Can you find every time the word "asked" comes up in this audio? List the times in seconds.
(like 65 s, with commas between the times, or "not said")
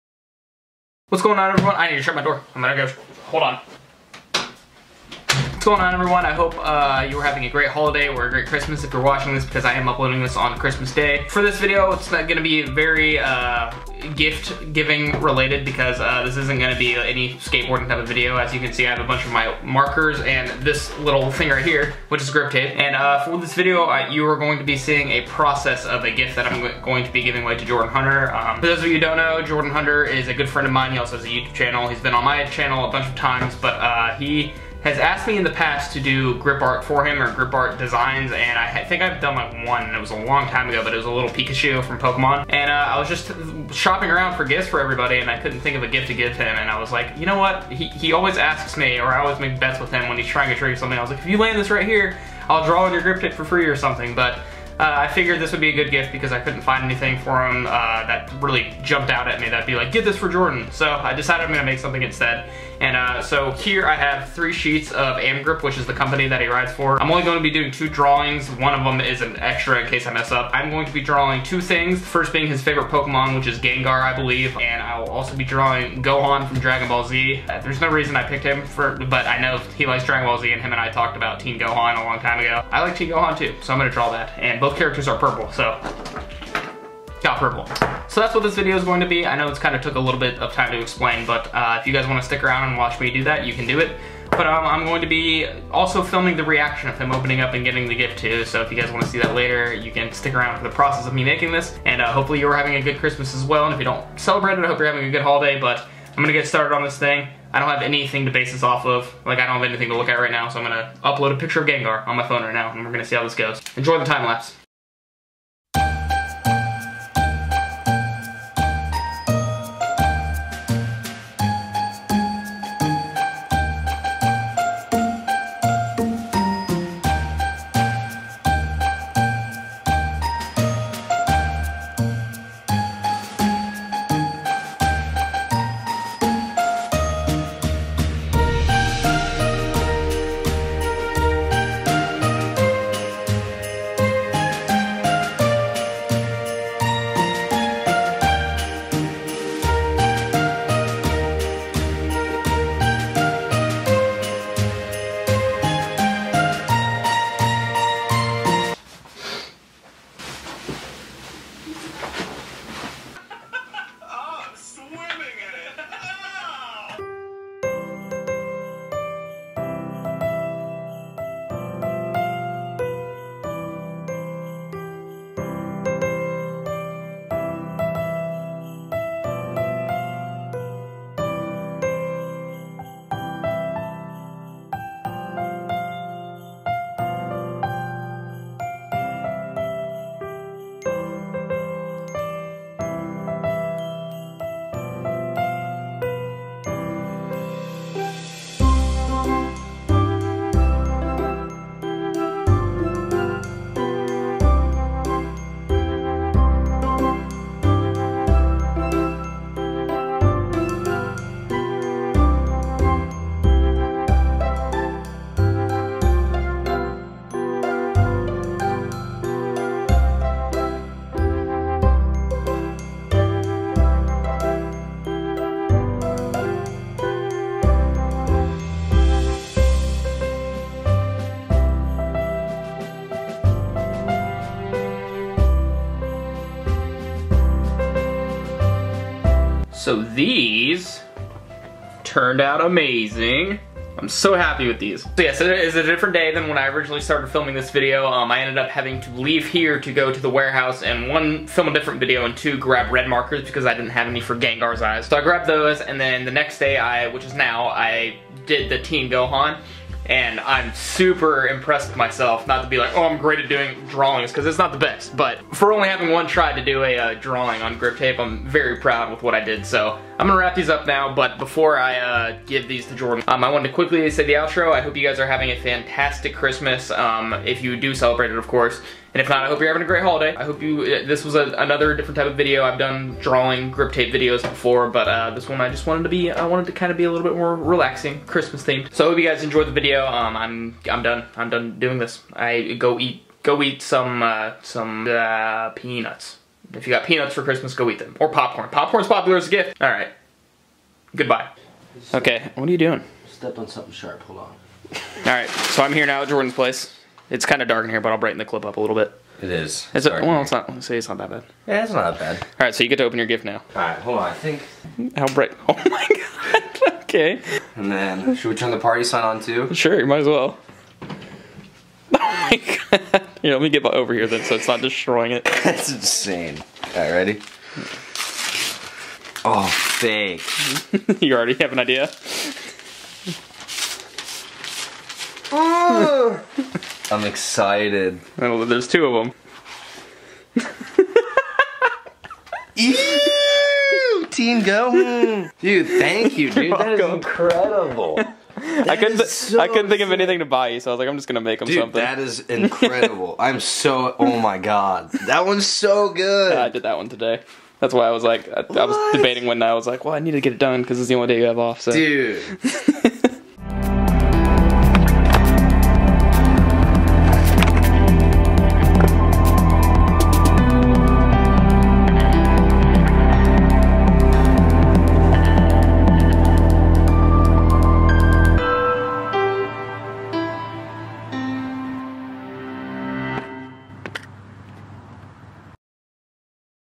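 34 s.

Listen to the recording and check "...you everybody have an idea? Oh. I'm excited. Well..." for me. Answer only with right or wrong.
wrong.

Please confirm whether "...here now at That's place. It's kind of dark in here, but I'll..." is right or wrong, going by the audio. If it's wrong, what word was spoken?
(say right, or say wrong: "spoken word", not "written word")
wrong: "Jordan", not "That".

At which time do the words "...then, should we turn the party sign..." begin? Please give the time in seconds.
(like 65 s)
317 s.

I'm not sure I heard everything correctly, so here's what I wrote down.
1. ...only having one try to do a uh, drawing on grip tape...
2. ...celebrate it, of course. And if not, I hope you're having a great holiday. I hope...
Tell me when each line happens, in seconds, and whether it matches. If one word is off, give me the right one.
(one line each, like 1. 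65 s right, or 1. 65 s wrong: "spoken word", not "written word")
1. 265 s right
2. 277 s right.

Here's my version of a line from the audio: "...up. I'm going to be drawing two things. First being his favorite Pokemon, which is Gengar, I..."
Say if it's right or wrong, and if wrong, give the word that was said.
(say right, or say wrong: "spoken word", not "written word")
right.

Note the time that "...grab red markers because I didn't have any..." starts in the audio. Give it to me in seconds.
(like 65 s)
252 s.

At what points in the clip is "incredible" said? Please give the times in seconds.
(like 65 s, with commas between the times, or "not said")
346 s, 352 s.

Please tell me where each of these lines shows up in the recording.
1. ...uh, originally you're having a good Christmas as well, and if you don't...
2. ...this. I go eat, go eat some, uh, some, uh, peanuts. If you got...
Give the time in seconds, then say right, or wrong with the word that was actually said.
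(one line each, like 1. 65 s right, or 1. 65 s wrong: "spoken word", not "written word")
1. 102 s wrong: "hopefully", not "originally"
2. 291 s right.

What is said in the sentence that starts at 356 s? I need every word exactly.
Yeah, I did that one today.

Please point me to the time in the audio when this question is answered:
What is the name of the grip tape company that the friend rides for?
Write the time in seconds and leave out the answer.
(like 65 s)
65 s.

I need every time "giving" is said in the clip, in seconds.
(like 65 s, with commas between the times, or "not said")
14 s, 27 s.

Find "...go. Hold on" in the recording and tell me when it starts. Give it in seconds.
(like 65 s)
2 s.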